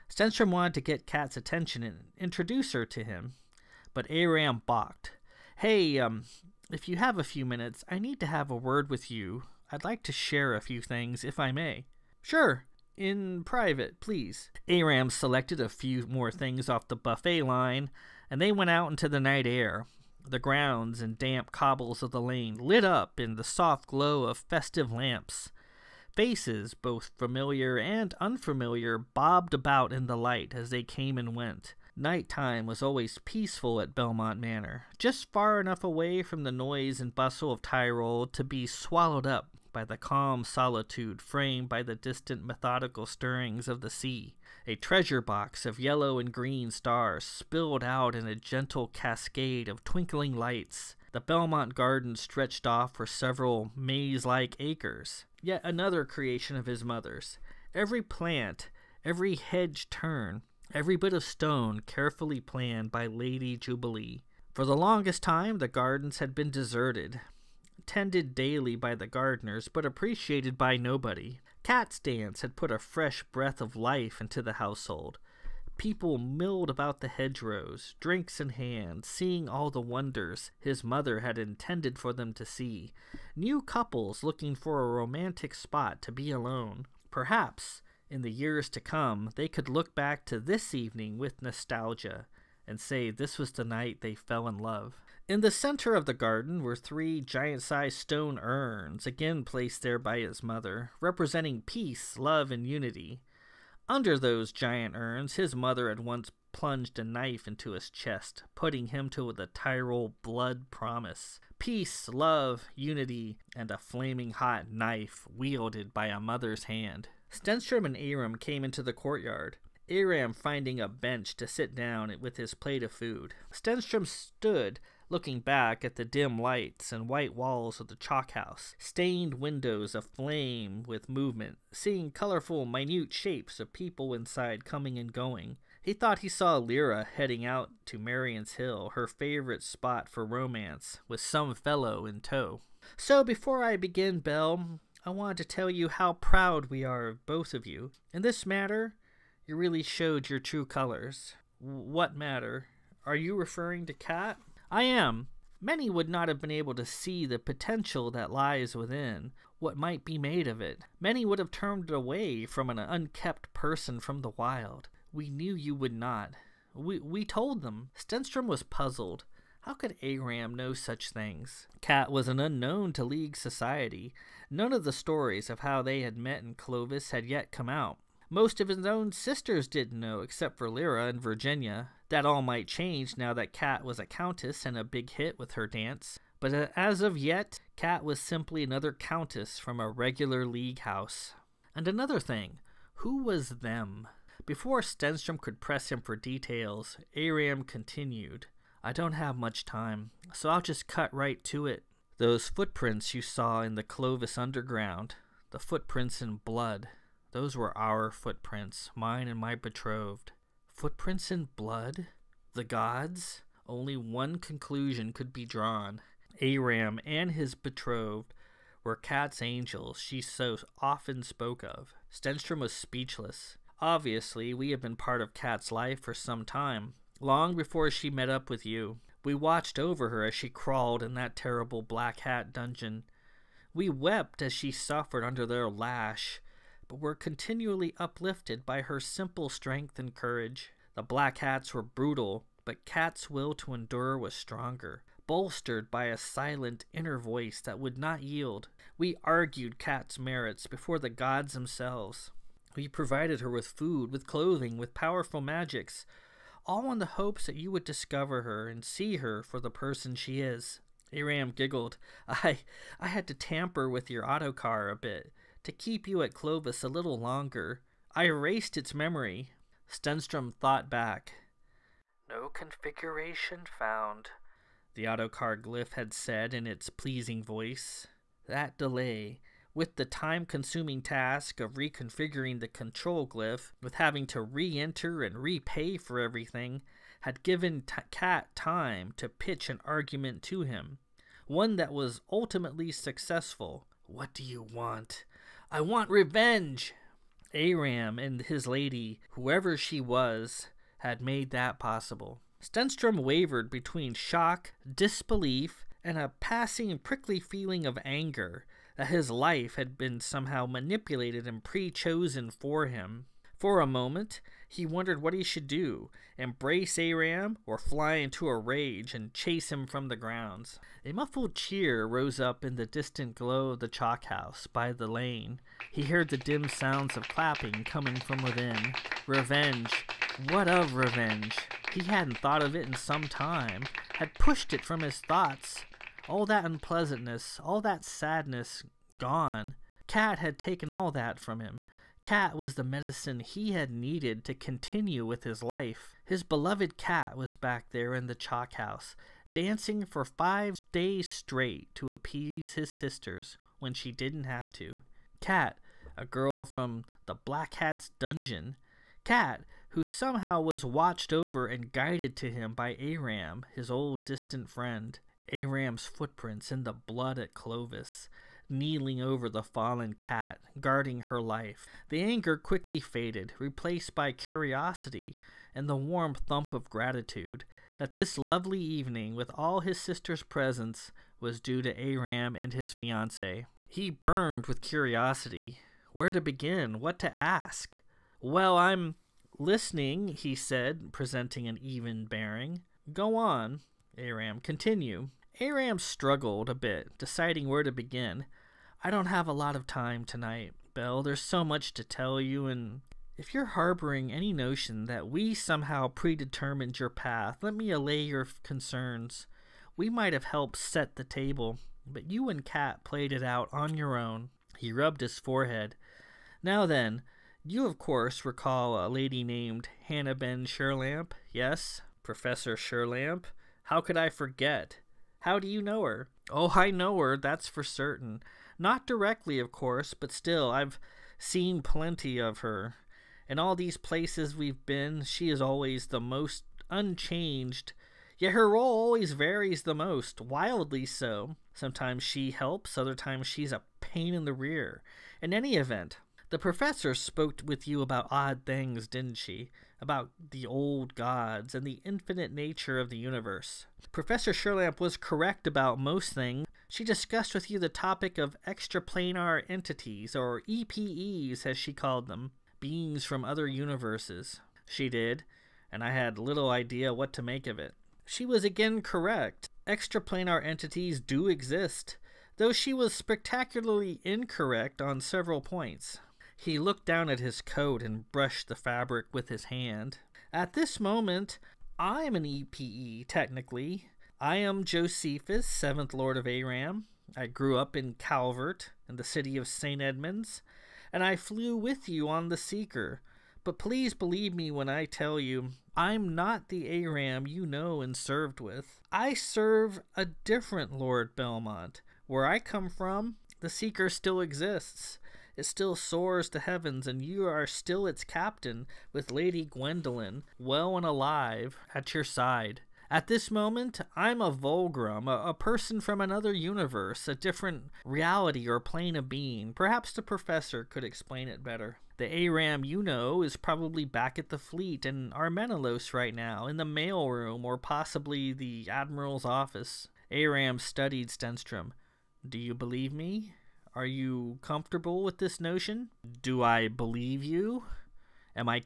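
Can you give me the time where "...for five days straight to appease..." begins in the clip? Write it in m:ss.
5:50.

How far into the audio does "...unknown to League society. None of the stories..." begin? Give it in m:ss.
2:52.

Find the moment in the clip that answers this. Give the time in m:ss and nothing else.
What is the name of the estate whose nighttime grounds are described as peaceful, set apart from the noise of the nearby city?
0:33.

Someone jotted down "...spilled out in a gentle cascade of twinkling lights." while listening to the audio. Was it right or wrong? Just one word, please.
right.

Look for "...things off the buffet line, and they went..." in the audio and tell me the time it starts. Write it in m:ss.
0:16.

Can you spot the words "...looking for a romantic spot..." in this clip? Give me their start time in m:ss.
1:24.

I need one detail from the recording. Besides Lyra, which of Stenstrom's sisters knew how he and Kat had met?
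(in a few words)
Virginia.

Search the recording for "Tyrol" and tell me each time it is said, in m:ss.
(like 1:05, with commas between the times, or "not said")
0:37, 1:49.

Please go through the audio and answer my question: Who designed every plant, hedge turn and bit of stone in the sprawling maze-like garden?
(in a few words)
Lady Jubilee.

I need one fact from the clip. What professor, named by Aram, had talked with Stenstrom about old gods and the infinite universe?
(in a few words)
Hannah Ben Sherlamp.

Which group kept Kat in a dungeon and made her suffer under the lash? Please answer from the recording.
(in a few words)
The Black Hats.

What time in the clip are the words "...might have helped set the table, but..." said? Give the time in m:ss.
6:50.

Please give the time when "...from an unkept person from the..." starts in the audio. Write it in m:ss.
2:42.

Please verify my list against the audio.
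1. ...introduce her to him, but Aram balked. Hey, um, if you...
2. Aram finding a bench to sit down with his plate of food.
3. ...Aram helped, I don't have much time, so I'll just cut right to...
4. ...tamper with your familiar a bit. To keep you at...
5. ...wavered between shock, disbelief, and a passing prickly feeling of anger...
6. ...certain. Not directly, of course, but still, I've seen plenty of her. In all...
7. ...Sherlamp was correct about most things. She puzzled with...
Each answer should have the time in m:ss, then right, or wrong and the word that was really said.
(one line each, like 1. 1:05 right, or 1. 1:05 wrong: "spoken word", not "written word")
1. 0:02 right
2. 1:59 right
3. 3:17 wrong: "continued", not "helped"
4. 4:23 wrong: "autocar", not "familiar"
5. 5:03 right
6. 7:07 right
7. 7:34 wrong: "discussed", not "puzzled".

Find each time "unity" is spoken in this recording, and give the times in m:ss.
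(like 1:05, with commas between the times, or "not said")
1:42, 1:52.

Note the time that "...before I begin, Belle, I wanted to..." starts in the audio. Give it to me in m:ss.
2:23.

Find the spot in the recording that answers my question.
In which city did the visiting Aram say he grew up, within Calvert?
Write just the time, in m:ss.
8:09.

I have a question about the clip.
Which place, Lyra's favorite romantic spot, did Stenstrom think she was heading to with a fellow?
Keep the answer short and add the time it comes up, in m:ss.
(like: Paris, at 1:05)
Marion's Hill, at 2:17.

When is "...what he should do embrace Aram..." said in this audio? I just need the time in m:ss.
5:15.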